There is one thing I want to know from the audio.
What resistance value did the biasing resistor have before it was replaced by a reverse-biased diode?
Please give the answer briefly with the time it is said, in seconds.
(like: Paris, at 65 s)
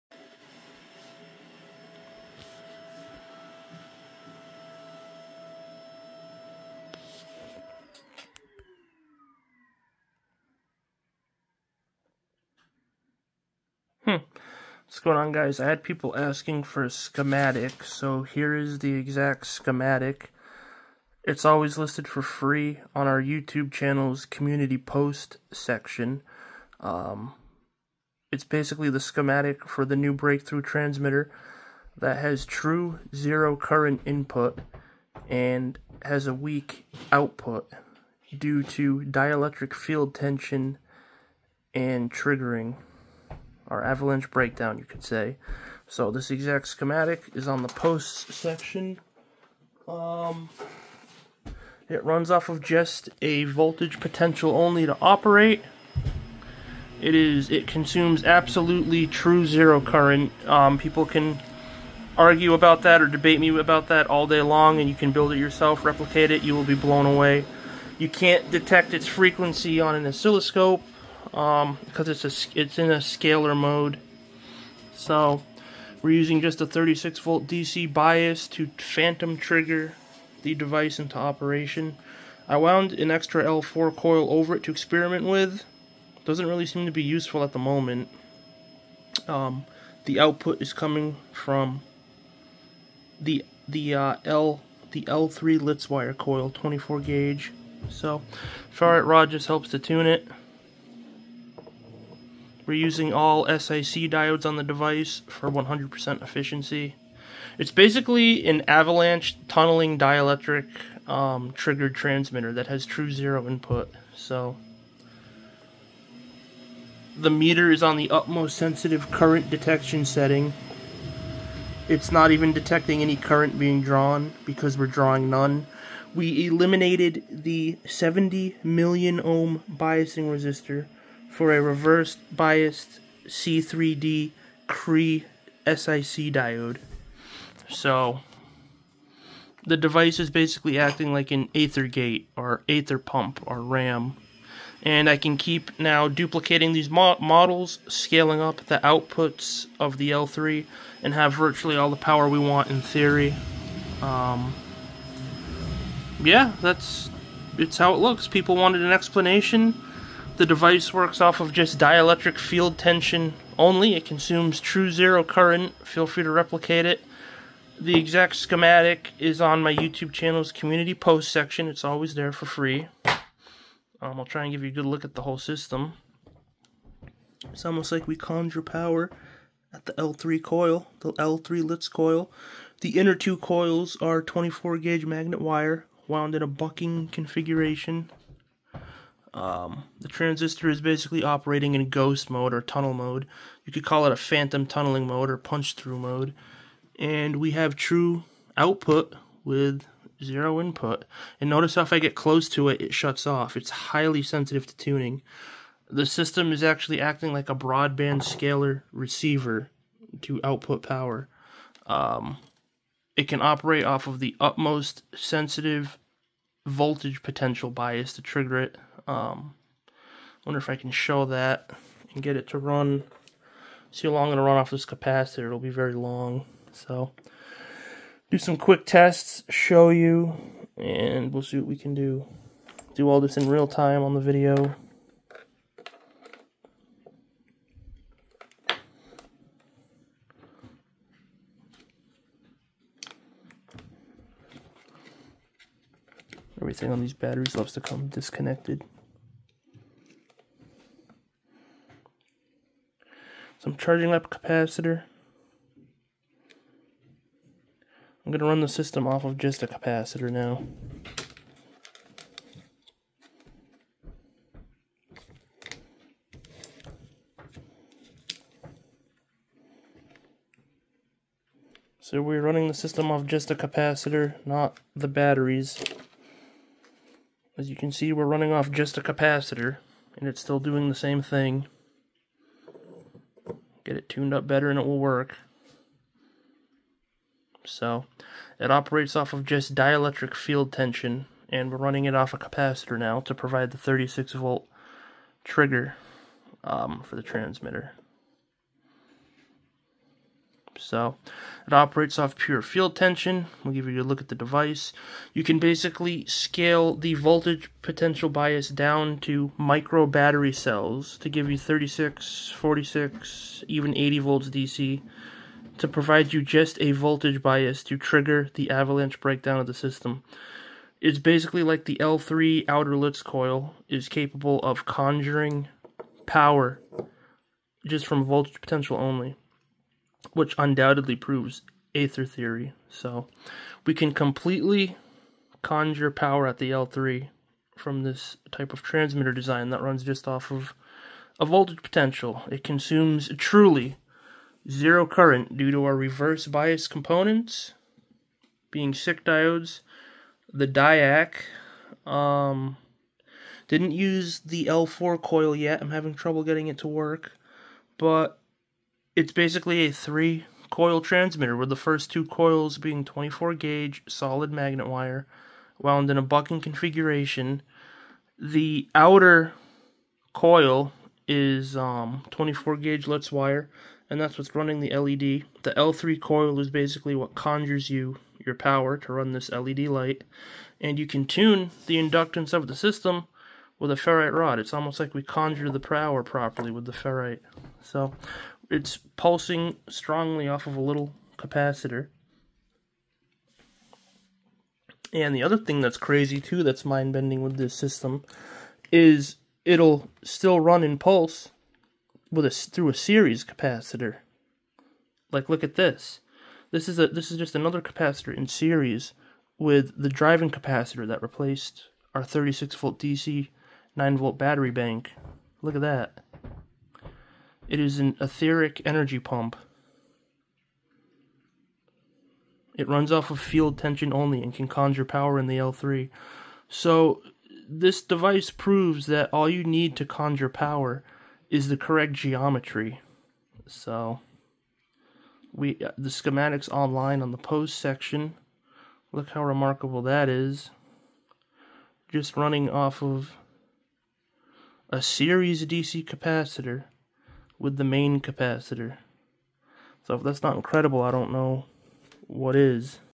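70 million ohm, at 127 s.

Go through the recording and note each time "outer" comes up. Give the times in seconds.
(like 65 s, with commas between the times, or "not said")
322 s, 368 s.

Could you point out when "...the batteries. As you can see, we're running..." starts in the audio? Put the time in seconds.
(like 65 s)
274 s.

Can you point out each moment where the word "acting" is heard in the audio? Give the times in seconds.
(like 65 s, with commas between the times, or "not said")
140 s, 207 s.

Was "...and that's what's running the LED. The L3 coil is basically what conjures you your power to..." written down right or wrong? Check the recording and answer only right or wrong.
right.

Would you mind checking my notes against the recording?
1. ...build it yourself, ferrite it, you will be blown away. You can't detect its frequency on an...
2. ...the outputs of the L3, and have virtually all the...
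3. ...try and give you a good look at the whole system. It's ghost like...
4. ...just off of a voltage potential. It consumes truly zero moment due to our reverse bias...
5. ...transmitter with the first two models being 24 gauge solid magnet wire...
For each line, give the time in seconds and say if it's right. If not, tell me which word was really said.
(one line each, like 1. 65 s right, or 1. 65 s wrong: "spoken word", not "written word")
1. 65 s wrong: "replicate", not "ferrite"
2. 148 s right
3. 174 s wrong: "almost", not "ghost"
4. 340 s wrong: "current", not "moment"
5. 361 s wrong: "coils", not "models".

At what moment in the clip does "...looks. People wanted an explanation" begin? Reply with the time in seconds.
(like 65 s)
157 s.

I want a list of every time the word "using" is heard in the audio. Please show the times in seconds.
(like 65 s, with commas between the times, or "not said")
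76 s, 102 s.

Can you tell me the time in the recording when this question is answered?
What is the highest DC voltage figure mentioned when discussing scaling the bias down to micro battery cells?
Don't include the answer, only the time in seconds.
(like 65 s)
313 s.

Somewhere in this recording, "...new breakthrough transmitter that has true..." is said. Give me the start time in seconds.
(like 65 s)
29 s.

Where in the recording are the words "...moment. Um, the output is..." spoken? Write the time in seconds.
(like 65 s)
87 s.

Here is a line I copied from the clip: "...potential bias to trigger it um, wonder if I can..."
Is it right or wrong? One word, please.
right.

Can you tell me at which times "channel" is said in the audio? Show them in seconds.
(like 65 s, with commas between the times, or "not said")
23 s, 170 s.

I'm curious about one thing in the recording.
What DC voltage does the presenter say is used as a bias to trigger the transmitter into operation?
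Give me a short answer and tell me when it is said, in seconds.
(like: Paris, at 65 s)
36 volt, at 76 s.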